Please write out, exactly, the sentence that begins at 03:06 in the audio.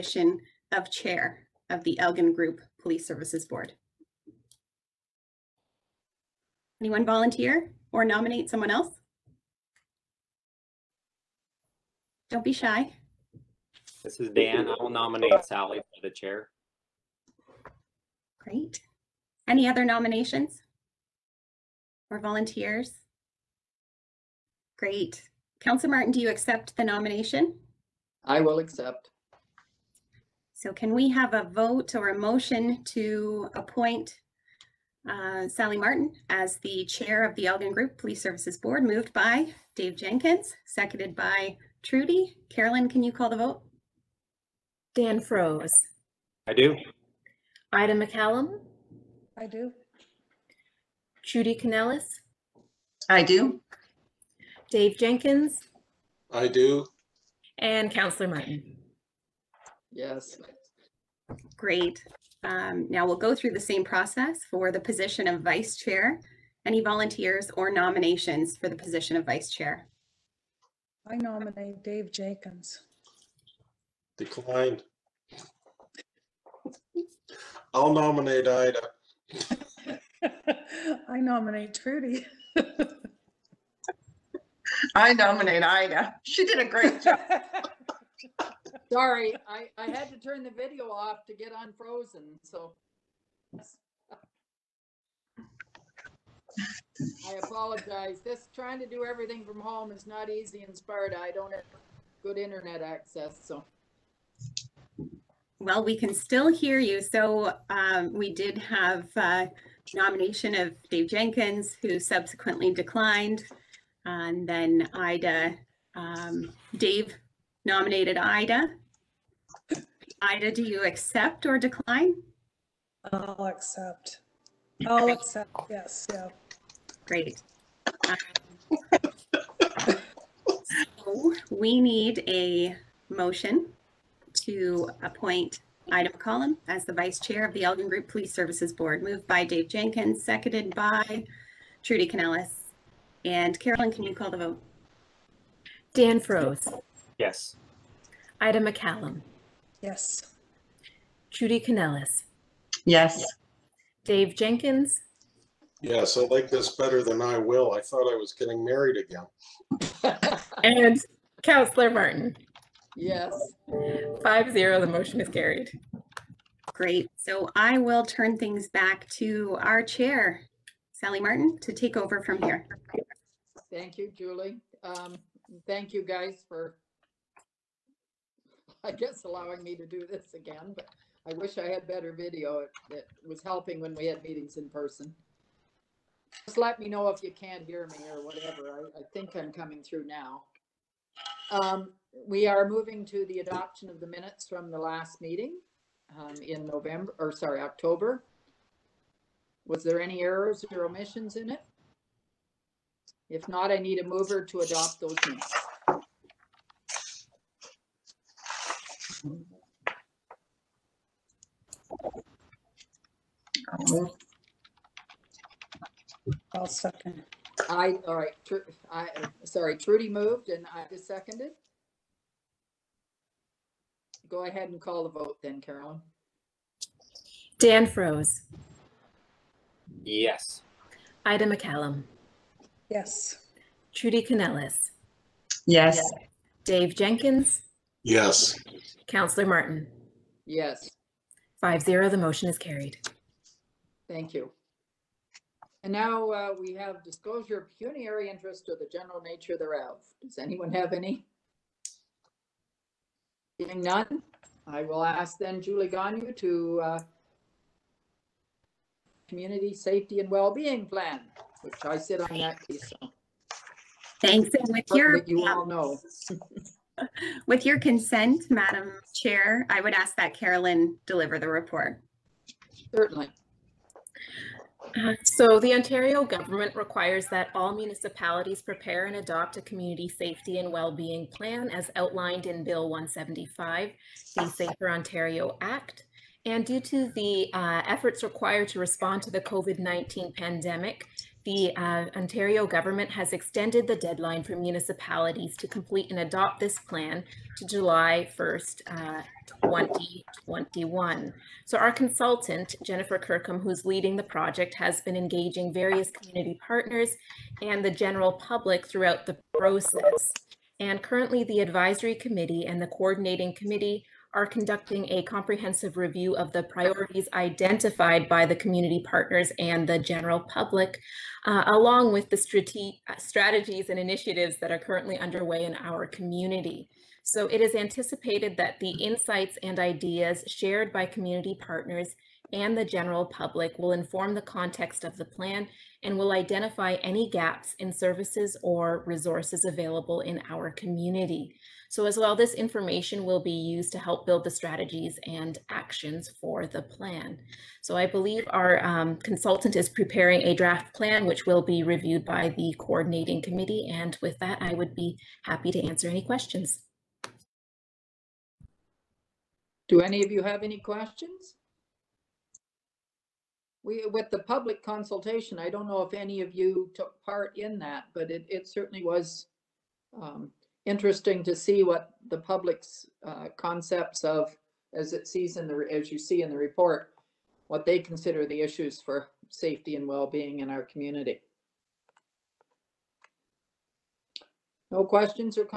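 Just let me know if you can't hear me or whatever.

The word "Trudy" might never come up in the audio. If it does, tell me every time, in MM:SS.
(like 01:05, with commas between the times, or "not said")
00:41, 00:51, 01:21, 02:21, 02:31, 03:39, 03:53.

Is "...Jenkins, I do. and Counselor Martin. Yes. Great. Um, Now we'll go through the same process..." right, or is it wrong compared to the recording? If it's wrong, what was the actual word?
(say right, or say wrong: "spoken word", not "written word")
right.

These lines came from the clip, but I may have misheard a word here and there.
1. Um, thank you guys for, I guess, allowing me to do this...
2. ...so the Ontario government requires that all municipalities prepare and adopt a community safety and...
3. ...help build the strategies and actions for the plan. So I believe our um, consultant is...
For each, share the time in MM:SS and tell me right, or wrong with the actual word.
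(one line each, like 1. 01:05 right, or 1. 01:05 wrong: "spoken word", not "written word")
1. 02:54 right
2. 04:35 right
3. 05:43 right.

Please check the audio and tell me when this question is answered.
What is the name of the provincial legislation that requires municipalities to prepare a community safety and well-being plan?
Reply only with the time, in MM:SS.
04:44.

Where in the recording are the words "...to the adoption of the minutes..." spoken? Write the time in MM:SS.
03:13.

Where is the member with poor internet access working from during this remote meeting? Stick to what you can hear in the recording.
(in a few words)
Sparta.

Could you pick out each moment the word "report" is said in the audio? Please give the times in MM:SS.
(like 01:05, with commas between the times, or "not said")
04:31, 06:16.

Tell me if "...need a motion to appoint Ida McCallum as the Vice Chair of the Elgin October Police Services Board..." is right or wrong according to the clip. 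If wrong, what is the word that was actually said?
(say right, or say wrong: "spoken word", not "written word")
wrong: "Group", not "October".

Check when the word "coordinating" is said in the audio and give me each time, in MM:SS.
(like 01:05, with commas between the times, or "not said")
05:12, 05:52.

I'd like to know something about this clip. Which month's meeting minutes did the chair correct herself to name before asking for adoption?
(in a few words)
October.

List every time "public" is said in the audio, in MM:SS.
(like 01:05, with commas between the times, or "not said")
05:08, 05:20, 05:33, 06:04, 06:12.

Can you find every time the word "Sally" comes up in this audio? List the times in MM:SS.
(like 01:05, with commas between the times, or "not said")
00:15, 00:35, 02:50.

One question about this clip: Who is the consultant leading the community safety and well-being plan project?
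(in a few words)
Jennifer Kirkham.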